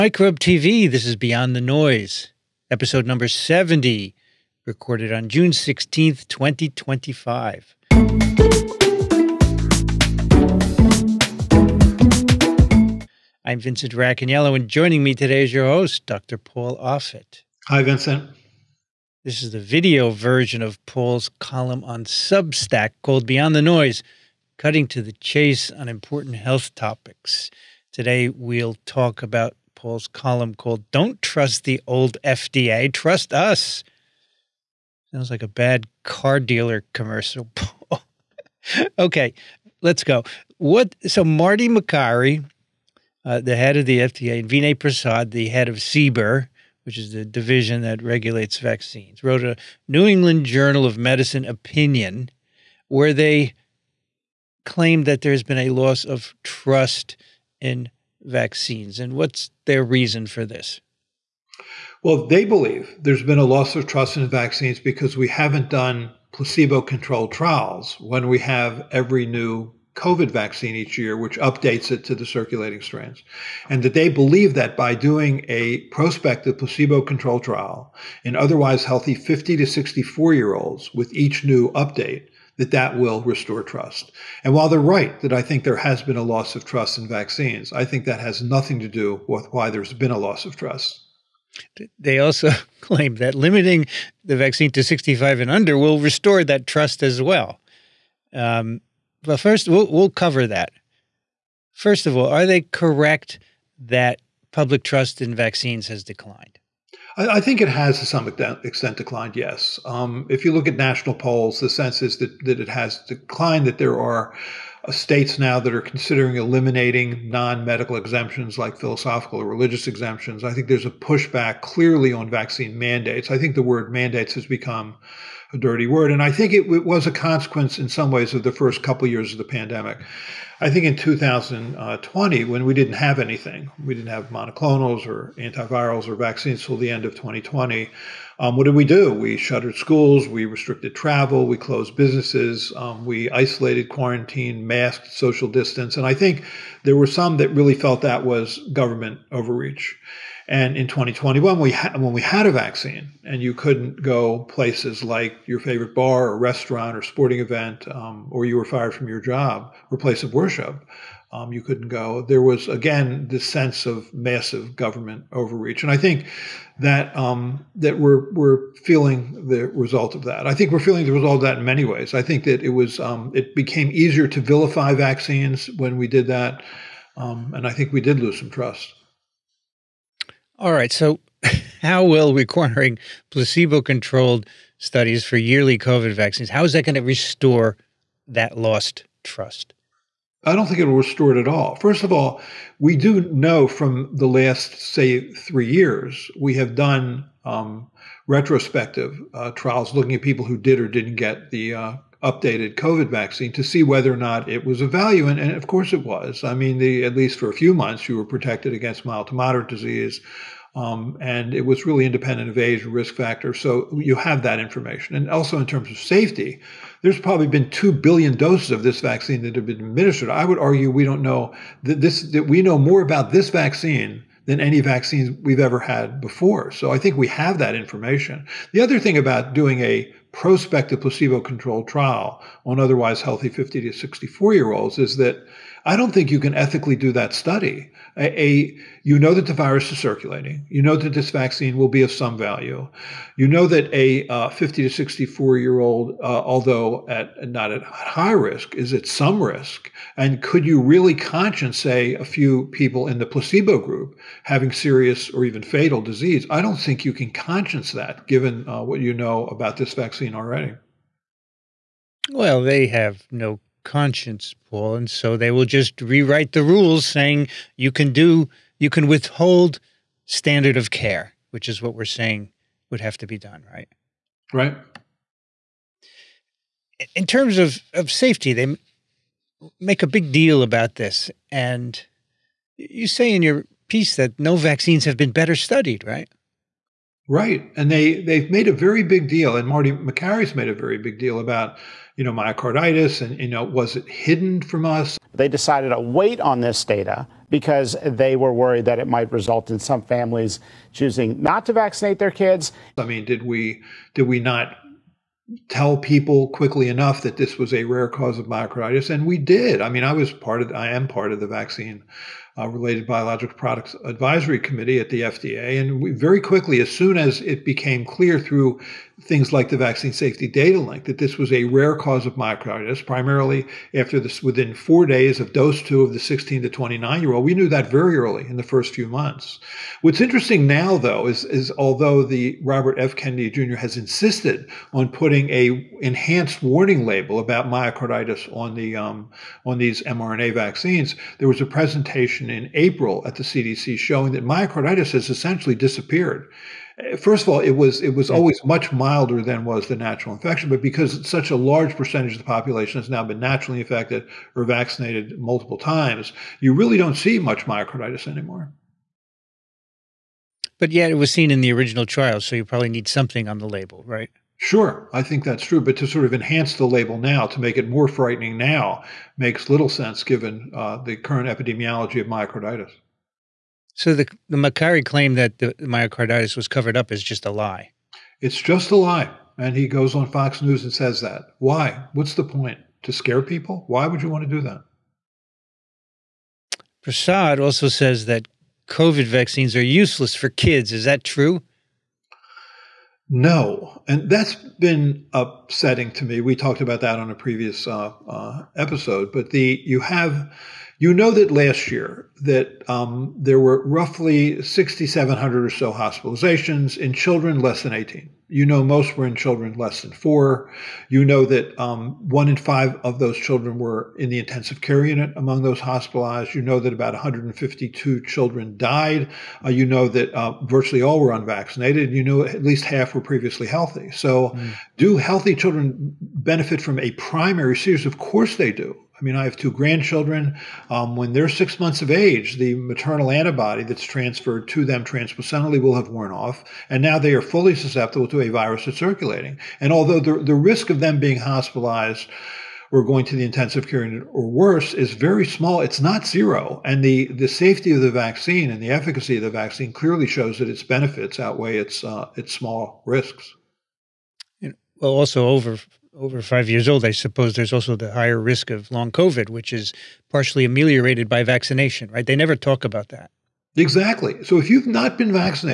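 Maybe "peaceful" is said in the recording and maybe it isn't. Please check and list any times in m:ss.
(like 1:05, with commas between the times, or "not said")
not said.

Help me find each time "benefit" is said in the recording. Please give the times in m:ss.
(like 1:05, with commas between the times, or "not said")
7:06, 7:30.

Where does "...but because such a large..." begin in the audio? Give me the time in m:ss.
5:50.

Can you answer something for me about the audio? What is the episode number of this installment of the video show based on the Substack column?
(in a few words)
70.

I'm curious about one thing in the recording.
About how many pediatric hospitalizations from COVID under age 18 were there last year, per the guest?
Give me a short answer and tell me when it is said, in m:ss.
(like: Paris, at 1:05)
6,700, at 6:44.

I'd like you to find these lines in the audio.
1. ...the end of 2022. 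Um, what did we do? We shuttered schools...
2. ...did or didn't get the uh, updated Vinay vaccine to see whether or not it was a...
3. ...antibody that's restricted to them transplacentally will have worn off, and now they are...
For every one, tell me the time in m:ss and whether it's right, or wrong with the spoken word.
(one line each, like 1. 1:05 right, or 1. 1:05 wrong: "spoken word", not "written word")
1. 2:16 wrong: "2020", not "2022"
2. 3:20 wrong: "COVID", not "Vinay"
3. 7:13 wrong: "transferred", not "restricted".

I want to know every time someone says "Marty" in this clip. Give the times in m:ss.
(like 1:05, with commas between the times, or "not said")
0:41, 4:49.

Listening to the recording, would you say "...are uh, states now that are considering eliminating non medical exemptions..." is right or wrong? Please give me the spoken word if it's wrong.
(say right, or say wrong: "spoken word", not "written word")
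right.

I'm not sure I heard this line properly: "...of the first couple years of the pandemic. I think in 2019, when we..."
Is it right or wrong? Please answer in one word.
wrong.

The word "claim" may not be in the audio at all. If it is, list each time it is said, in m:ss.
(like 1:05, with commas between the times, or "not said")
0:54, 1:32, 6:15.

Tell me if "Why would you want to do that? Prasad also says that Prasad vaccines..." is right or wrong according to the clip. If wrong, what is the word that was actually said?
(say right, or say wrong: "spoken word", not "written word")
wrong: "COVID", not "Prasad".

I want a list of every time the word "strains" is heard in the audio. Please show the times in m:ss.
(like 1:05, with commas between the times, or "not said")
1:12.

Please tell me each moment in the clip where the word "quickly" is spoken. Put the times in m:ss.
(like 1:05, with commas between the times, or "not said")
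5:06, 5:16.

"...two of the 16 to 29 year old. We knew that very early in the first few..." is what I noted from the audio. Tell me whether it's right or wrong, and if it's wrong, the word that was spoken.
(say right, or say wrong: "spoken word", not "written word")
right.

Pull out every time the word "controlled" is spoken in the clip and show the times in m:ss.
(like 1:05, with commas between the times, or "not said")
1:06, 1:17, 3:03, 3:51.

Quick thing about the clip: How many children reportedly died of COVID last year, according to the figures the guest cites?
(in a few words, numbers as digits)
152.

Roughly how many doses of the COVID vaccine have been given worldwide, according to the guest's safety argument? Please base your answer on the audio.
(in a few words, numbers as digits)
2 billion.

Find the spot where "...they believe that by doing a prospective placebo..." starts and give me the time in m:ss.
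1:13.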